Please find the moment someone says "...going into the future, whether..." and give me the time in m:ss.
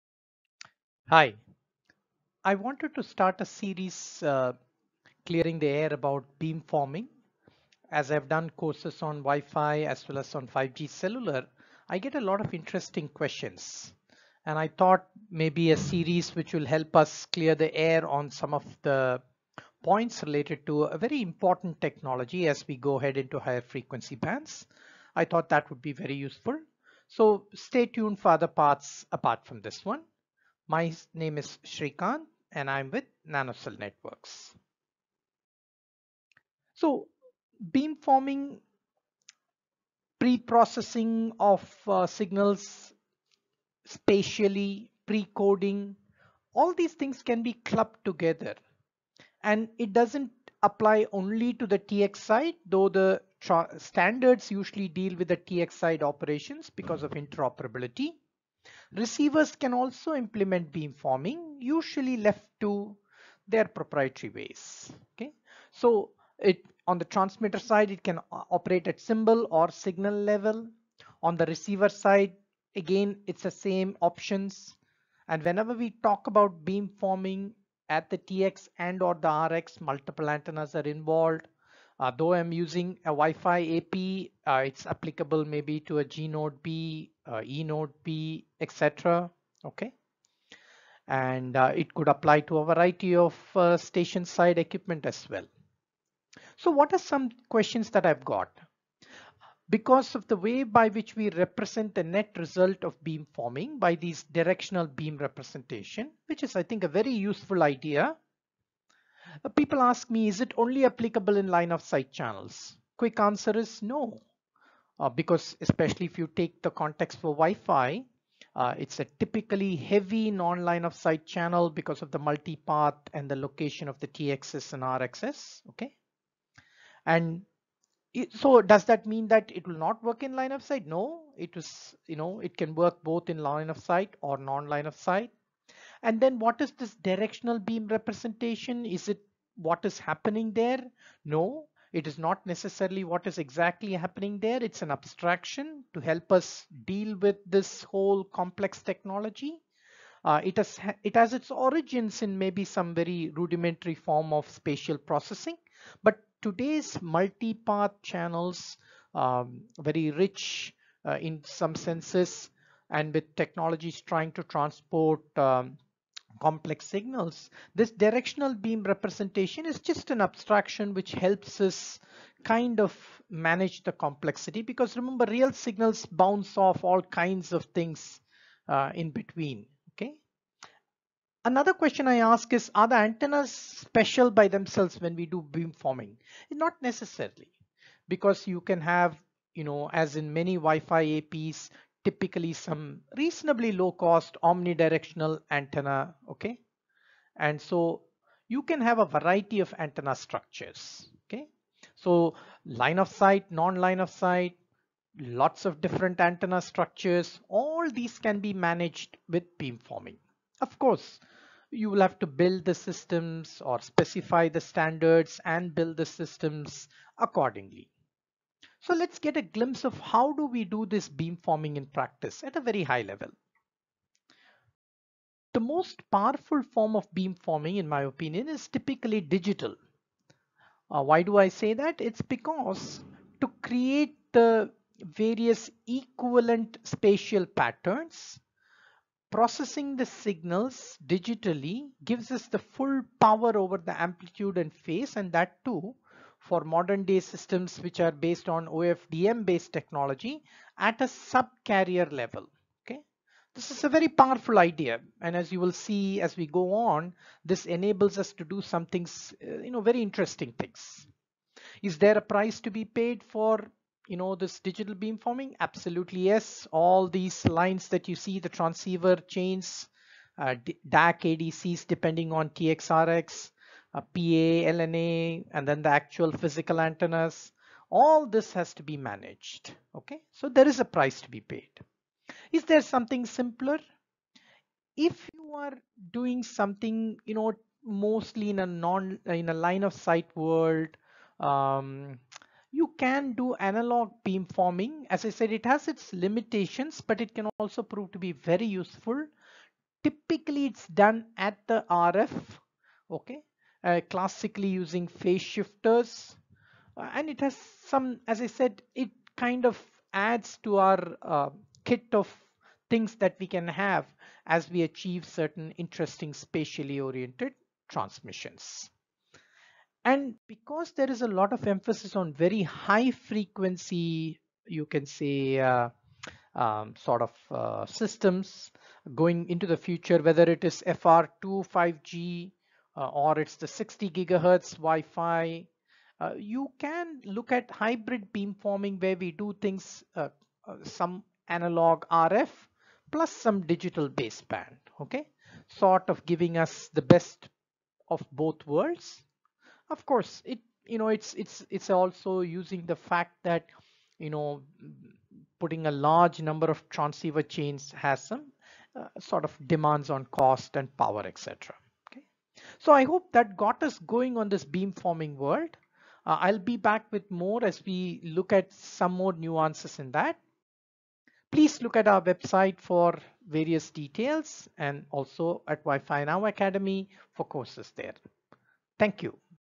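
5:29.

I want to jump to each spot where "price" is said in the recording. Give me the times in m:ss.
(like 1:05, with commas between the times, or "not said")
4:22, 4:40.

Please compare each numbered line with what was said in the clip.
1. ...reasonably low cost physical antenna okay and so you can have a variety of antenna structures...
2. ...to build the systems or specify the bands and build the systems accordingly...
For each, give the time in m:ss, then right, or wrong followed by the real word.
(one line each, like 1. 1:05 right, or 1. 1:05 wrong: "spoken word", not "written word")
1. 3:13 wrong: "omnidirectional", not "physical"
2. 3:32 wrong: "standards", not "bands".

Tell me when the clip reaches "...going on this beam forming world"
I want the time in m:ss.
6:03.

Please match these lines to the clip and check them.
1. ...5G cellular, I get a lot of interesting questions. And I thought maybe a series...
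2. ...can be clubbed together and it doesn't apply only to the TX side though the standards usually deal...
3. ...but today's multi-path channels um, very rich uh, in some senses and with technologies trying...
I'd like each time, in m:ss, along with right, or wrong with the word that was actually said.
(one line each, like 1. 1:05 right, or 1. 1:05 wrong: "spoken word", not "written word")
1. 0:10 right
2. 0:47 right
3. 2:36 right.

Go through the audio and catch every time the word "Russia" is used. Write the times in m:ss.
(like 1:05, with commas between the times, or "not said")
not said.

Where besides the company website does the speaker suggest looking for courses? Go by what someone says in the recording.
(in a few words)
Wi-Fi Now Academy.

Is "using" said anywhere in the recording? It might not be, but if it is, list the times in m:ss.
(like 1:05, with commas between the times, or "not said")
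1:22, 5:04, 5:52.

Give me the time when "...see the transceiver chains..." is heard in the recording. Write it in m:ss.
4:28.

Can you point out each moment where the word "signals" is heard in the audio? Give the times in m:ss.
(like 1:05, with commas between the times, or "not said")
0:42, 1:09, 2:46, 2:55, 4:00.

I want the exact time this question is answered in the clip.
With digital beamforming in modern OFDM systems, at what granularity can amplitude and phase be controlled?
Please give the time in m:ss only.
4:11.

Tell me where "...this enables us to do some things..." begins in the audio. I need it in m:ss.
4:17.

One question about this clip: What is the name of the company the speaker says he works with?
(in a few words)
NanoCell Networks.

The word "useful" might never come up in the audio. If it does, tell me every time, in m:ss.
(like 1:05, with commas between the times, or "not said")
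0:26, 1:47, 4:58.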